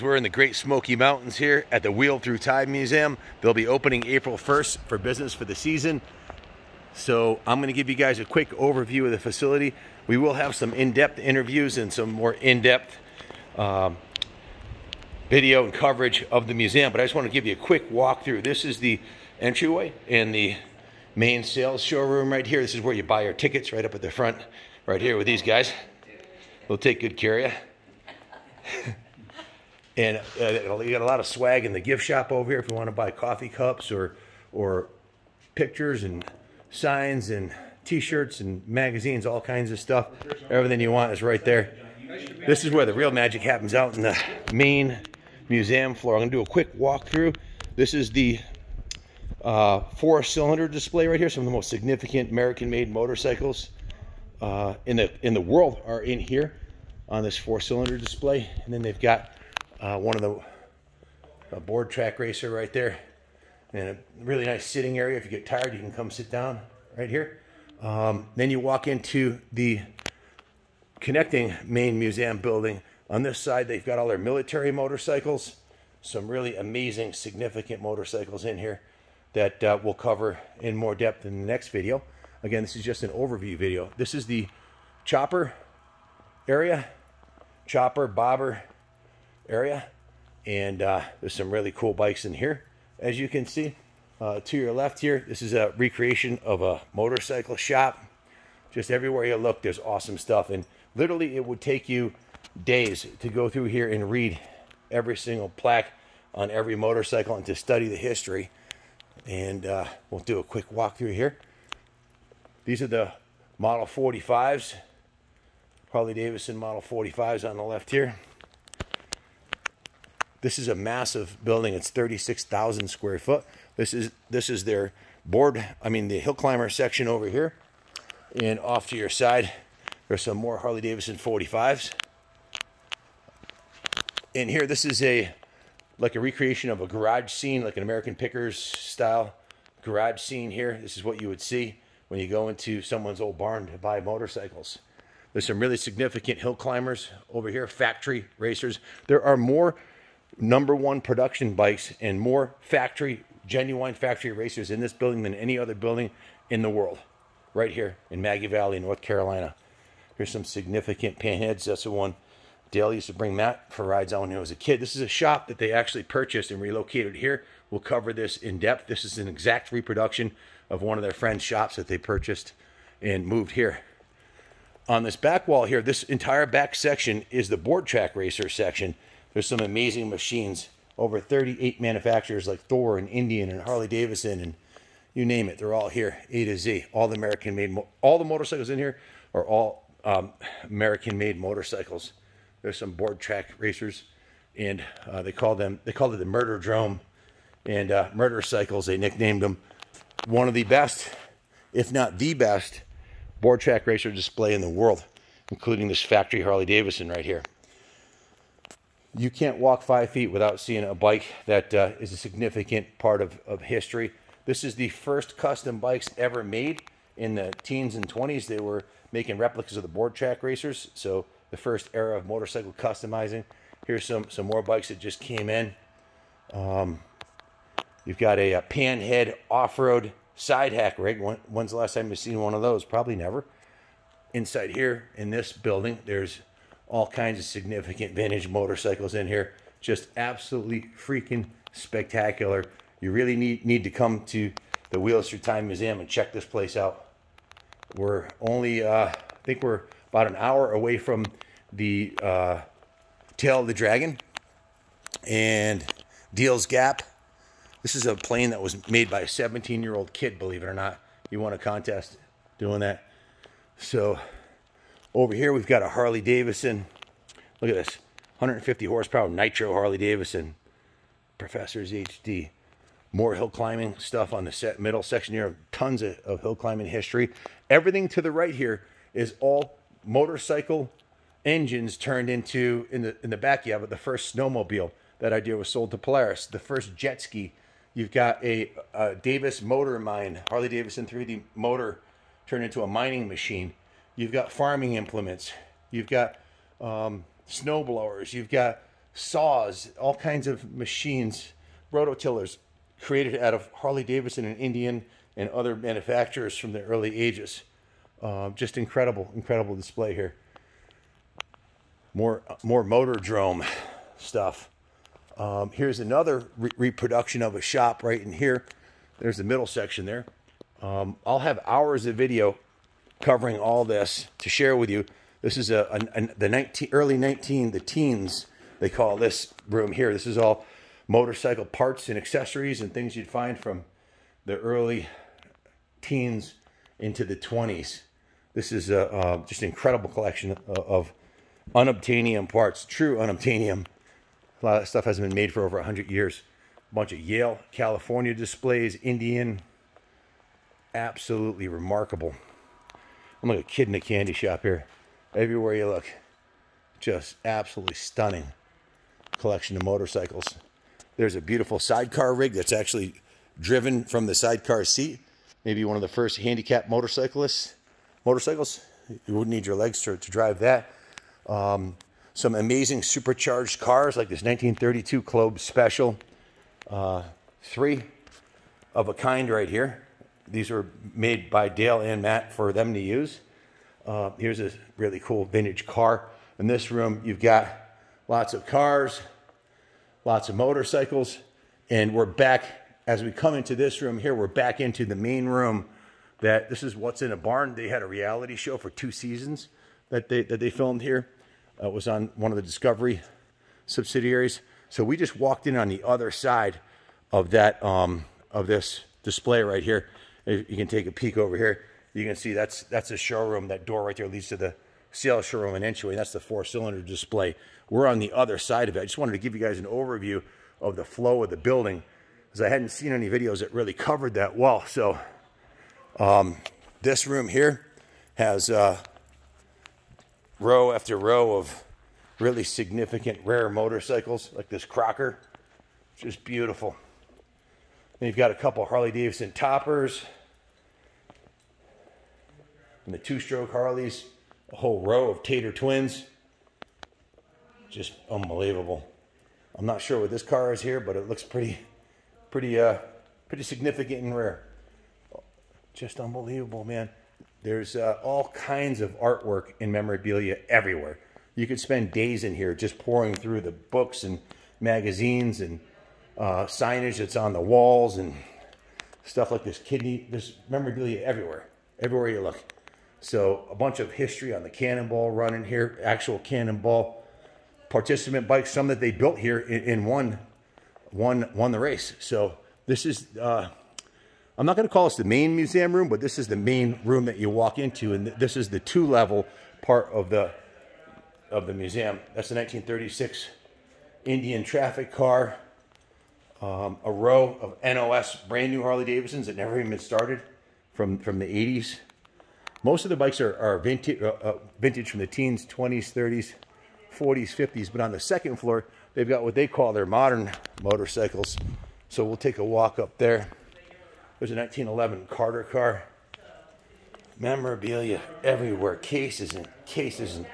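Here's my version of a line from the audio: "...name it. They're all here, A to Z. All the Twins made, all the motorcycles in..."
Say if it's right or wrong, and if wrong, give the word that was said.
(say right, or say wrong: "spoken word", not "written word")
wrong: "American", not "Twins".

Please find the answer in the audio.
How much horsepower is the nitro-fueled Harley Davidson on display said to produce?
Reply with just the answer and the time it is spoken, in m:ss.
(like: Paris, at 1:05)
150, at 4:28.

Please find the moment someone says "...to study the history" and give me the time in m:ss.
1:47.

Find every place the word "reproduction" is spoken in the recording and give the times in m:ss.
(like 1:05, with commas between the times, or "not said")
2:49, 5:16.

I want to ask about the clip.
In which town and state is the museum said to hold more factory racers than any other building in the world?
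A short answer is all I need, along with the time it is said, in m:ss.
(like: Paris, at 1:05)
Maggie Valley, North Carolina, at 2:38.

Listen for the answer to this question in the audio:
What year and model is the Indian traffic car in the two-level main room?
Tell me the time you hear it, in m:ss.
8:12.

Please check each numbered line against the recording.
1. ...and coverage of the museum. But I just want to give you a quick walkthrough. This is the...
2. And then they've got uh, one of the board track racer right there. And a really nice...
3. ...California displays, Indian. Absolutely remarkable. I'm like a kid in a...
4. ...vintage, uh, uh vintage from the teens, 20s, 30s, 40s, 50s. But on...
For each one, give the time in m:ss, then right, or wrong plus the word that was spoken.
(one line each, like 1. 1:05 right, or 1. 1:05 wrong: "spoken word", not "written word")
1. 0:15 right
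2. 0:58 right
3. 5:47 right
4. 8:23 right.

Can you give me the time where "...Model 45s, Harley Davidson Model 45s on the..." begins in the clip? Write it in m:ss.
1:53.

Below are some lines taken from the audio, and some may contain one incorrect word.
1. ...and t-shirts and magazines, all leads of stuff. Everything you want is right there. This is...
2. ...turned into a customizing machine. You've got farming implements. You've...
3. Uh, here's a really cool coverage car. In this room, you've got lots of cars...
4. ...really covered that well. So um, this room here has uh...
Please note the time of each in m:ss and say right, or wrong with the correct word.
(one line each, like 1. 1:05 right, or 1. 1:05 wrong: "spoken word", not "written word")
1. 0:37 wrong: "kinds", not "leads"
2. 4:52 wrong: "mining", not "customizing"
3. 6:24 wrong: "vintage", not "coverage"
4. 7:03 right.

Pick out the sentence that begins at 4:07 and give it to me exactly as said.
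We're only, uh, I think we're about an hour away from the uh, Tail of the Dragon and Deals Gap.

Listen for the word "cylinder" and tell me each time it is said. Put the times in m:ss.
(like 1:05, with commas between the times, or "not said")
0:49, 0:57, 6:56.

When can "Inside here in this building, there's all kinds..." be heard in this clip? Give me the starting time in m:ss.
3:54.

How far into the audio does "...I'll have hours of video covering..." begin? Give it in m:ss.
5:21.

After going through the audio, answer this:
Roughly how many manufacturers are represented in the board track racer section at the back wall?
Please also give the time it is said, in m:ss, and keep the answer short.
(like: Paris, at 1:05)
Over 38, at 3:00.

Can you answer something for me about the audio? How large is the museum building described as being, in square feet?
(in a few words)
36,000.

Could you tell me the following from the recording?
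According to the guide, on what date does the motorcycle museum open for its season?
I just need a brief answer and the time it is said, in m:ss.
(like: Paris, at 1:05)
April 1st, at 0:04.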